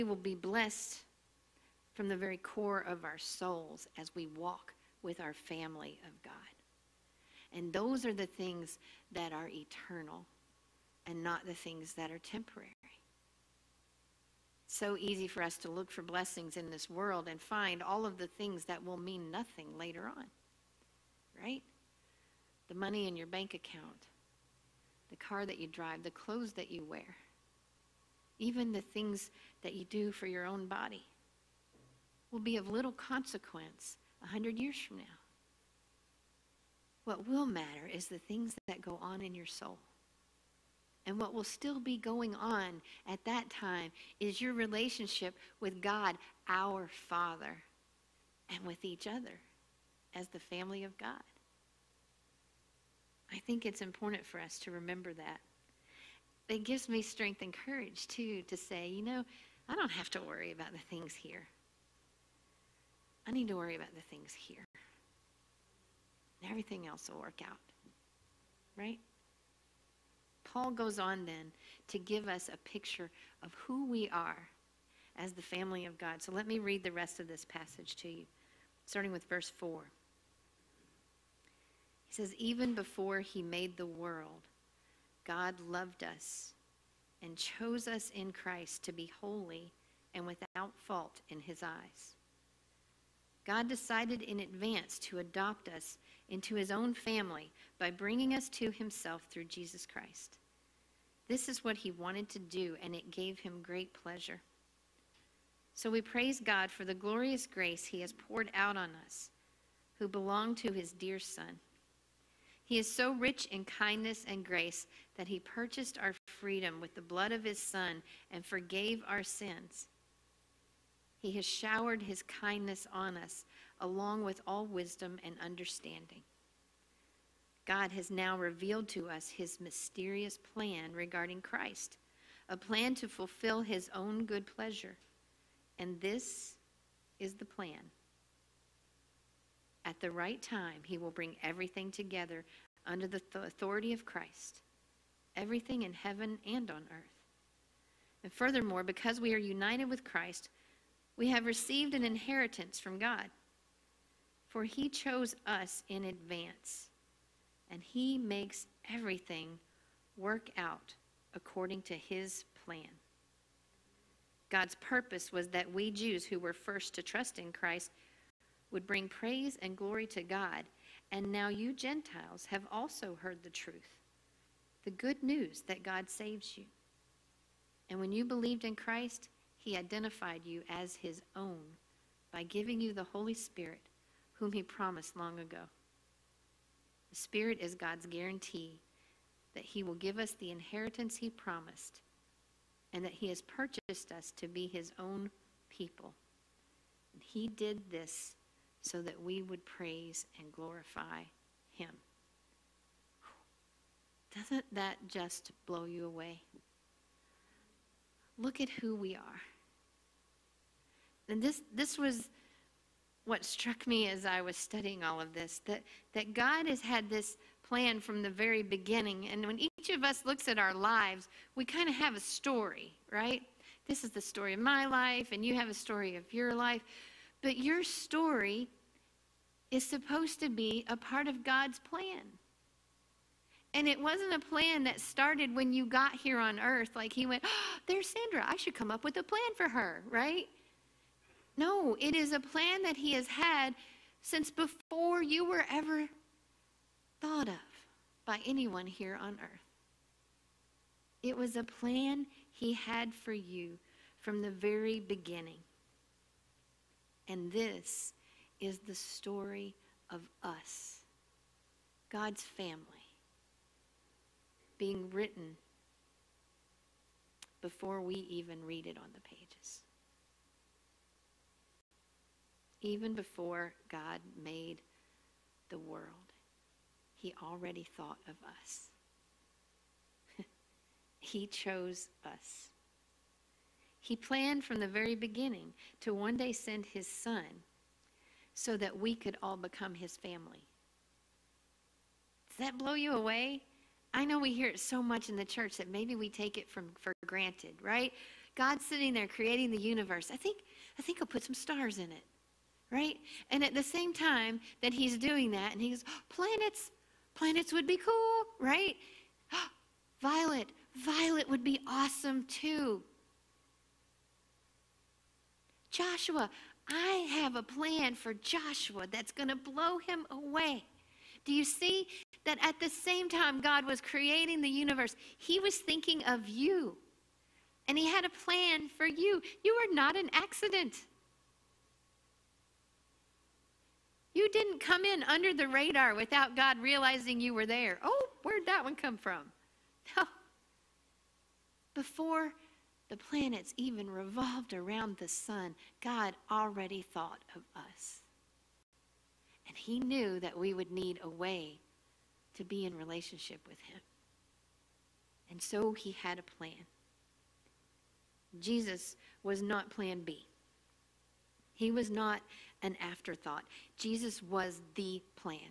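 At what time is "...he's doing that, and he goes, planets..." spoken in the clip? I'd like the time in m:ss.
5:04.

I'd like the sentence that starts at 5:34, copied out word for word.
You didn't come in under the radar without God realizing you were there.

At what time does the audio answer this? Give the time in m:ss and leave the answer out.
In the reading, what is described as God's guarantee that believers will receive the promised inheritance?
3:07.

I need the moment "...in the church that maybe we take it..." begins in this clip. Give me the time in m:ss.
4:55.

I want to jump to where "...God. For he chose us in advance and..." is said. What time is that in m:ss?
2:32.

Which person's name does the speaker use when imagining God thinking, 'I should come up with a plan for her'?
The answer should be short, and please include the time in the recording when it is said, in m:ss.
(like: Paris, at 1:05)
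Sandra, at 3:58.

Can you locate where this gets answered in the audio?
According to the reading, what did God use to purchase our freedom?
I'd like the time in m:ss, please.
1:56.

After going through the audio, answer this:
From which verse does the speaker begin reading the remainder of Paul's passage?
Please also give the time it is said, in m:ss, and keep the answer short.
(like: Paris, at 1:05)
Verse 4, at 1:19.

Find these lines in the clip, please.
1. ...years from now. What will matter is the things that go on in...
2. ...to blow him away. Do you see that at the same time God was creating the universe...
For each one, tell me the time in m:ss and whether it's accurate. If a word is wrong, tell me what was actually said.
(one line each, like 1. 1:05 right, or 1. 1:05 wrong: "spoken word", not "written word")
1. 0:34 right
2. 5:19 right.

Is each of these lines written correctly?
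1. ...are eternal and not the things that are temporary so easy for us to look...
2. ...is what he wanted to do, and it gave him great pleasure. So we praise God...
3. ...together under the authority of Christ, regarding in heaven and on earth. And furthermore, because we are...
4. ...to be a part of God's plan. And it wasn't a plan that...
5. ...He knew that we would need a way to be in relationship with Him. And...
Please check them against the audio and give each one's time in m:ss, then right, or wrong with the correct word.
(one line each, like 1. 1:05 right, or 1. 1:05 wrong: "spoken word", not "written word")
1. 0:09 right
2. 1:41 right
3. 2:21 wrong: "everything", not "regarding"
4. 3:50 right
5. 5:49 right.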